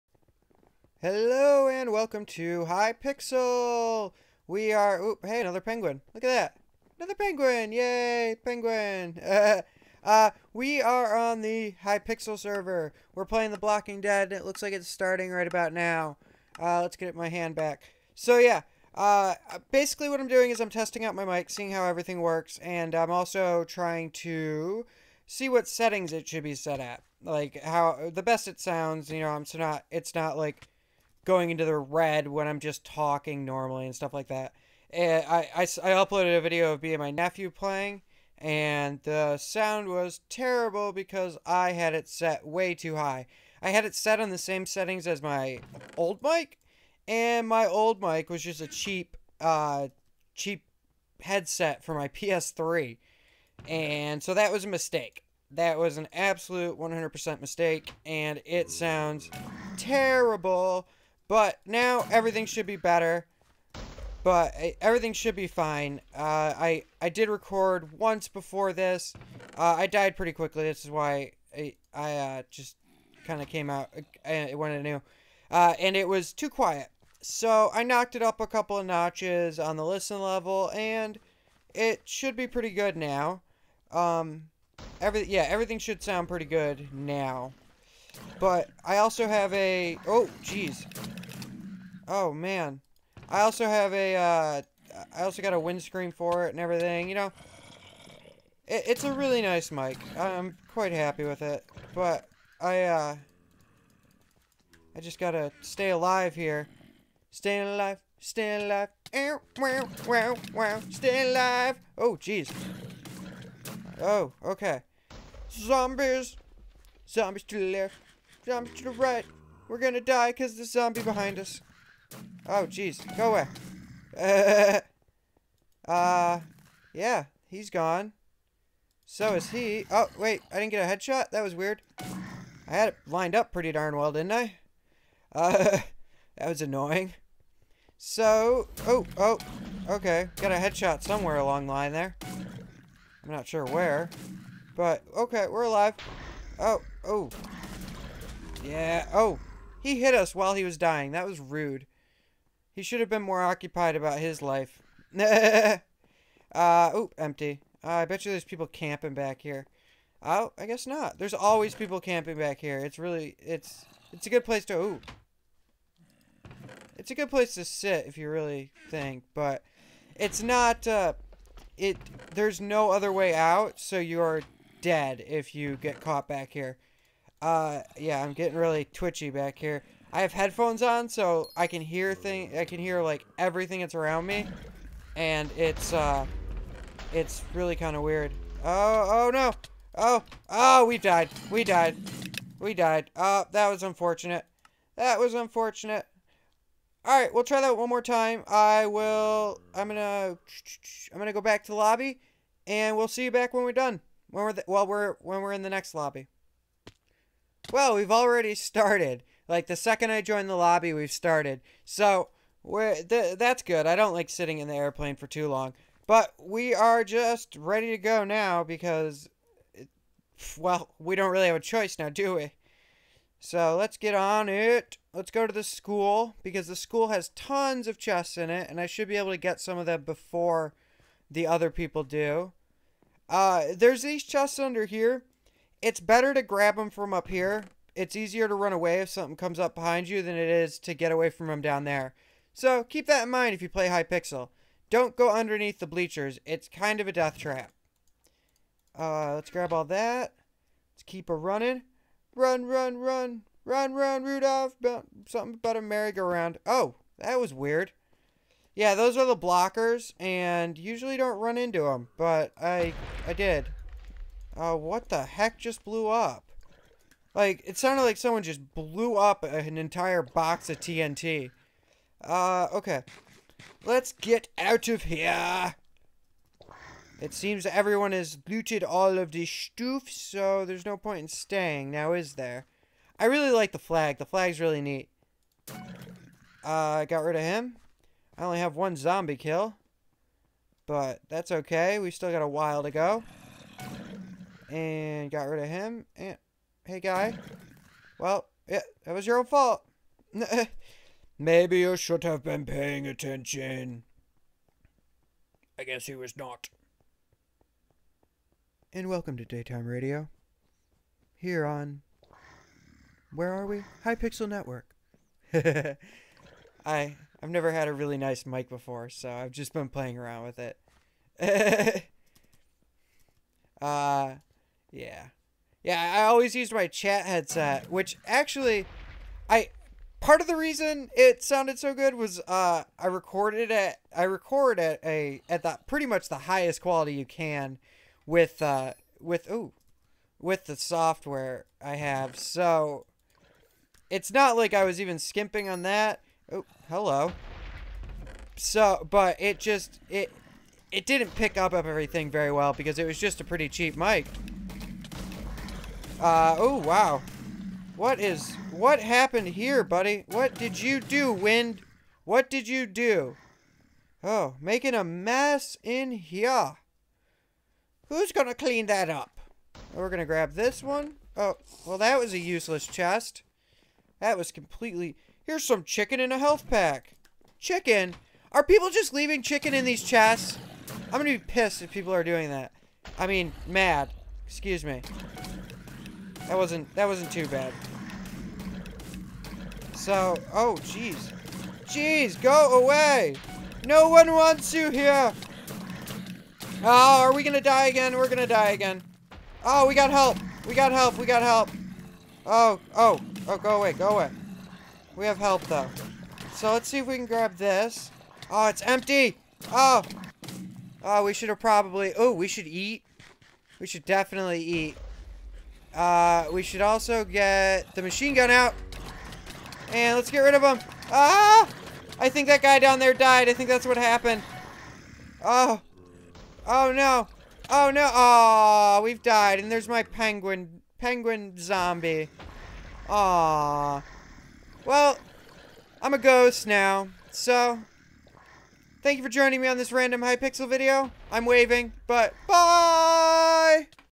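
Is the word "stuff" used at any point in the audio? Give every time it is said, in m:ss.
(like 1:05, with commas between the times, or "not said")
0:33, 4:39.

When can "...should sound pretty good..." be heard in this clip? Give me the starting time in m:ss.
1:25.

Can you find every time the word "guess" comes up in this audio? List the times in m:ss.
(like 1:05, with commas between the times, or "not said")
2:40, 5:05.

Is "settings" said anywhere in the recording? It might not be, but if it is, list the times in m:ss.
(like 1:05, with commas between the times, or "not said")
0:25, 0:44.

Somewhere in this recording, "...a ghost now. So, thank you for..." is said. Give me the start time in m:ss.
7:16.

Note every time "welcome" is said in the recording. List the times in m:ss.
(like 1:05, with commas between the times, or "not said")
0:01, 5:09.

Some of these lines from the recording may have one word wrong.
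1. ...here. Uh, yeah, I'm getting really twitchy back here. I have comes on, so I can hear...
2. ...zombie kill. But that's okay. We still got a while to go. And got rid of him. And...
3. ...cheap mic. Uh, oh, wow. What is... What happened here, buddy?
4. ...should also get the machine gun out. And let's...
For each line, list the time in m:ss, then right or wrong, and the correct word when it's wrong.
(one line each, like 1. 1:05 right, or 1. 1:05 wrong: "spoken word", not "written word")
1. 2:56 wrong: "headphones", not "comes"
2. 4:48 right
3. 5:53 right
4. 6:56 right.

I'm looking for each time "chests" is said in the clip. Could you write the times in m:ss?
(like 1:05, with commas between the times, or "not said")
3:47, 3:54, 6:12, 6:20.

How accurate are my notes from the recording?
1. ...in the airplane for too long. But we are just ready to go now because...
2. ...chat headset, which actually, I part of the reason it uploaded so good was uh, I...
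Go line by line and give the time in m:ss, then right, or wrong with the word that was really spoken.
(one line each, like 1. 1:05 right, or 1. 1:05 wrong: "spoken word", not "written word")
1. 3:34 right
2. 5:26 wrong: "sounded", not "uploaded".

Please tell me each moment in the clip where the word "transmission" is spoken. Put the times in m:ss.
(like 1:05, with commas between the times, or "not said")
not said.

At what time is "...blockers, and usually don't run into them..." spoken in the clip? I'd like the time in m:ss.
4:19.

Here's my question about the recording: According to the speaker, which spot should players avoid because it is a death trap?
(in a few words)
underneath the bleachers.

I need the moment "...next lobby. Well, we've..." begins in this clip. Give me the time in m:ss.
3:25.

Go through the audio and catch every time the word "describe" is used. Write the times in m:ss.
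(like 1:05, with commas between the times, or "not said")
not said.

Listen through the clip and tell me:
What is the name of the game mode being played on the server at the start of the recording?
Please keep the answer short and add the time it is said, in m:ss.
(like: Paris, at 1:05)
The Blocking Dead, at 0:13.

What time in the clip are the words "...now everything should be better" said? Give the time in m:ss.
1:01.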